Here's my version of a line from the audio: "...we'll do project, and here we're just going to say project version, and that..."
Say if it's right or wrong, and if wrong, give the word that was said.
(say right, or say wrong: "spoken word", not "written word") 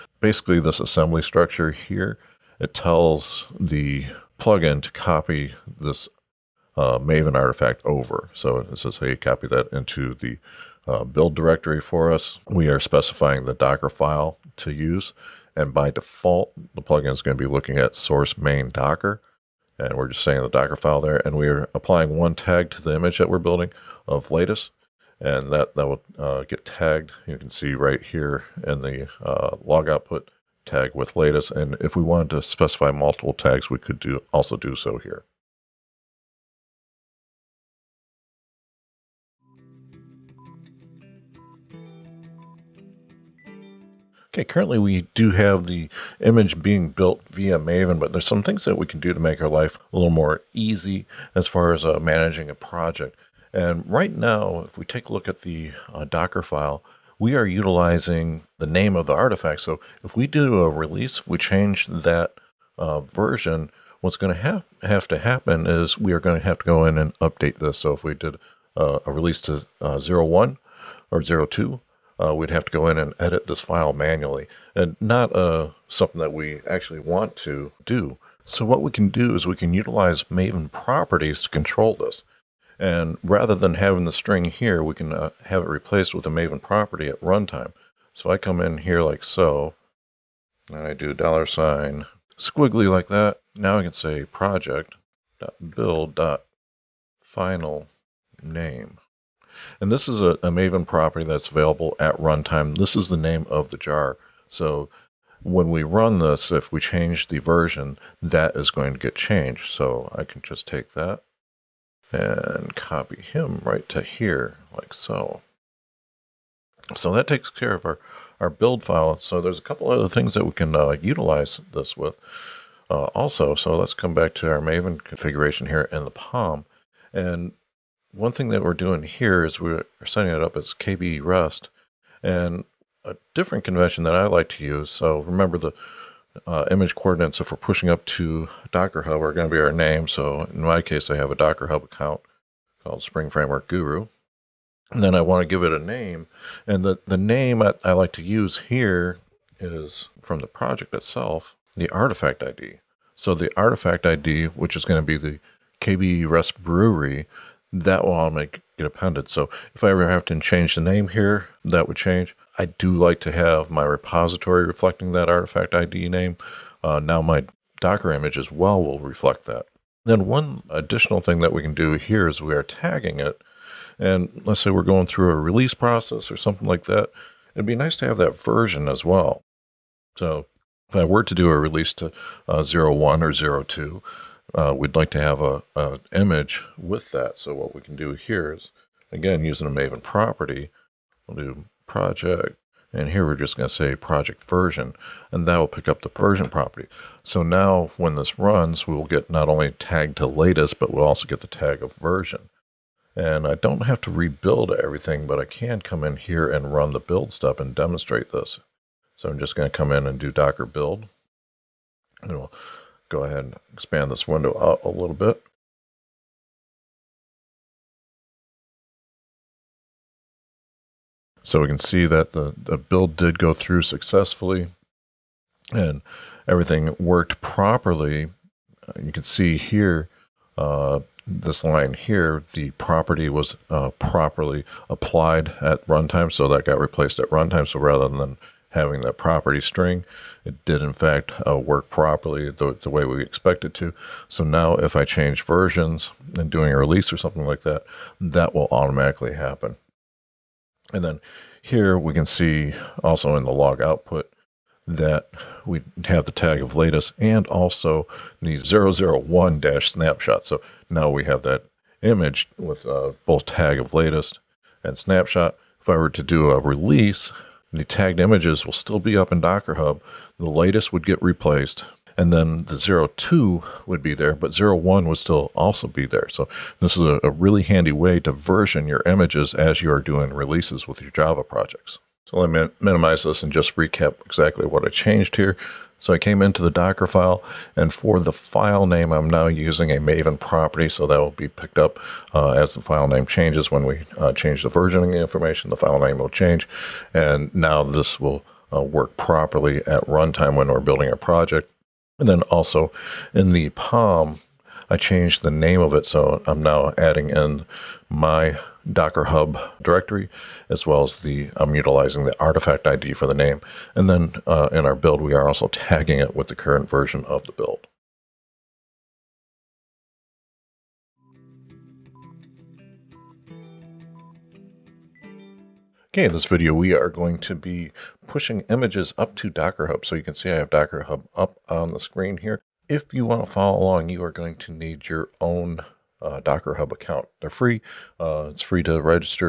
right.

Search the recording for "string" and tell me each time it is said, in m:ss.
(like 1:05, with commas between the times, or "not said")
1:24, 3:59.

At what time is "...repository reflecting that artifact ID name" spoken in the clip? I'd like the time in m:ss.
2:43.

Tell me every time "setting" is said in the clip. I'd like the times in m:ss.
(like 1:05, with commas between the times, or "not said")
2:10.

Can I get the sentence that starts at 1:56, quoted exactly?
So that takes care of our, our build file.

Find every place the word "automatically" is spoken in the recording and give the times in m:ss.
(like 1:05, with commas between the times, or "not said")
2:38, 4:08.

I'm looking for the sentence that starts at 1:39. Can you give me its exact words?
And this is a, a, Maven property that's available at runtime.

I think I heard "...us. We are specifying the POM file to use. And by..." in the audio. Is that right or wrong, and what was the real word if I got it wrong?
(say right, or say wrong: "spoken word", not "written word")
wrong: "Docker", not "POM".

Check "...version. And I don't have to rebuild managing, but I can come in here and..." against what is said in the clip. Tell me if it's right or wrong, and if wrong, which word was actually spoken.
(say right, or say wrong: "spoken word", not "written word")
wrong: "everything", not "managing".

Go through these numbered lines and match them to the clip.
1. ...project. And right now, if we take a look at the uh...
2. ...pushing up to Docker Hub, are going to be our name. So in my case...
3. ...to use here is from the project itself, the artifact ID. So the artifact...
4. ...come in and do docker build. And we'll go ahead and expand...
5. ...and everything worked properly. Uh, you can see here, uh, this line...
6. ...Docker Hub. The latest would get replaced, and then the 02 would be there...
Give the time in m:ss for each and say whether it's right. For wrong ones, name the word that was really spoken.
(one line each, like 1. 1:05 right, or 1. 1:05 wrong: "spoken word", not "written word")
1. 0:52 right
2. 2:17 right
3. 2:28 right
4. 3:29 right
5. 3:45 right
6. 4:29 right.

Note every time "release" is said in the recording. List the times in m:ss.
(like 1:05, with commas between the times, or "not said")
1:00, 1:09, 2:55, 3:01, 4:06, 4:26, 4:40.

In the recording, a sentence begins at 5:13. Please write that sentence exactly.
And then uh, in our build, we are also tagging it with the current version of the build.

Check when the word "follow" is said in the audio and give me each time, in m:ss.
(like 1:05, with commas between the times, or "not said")
5:33.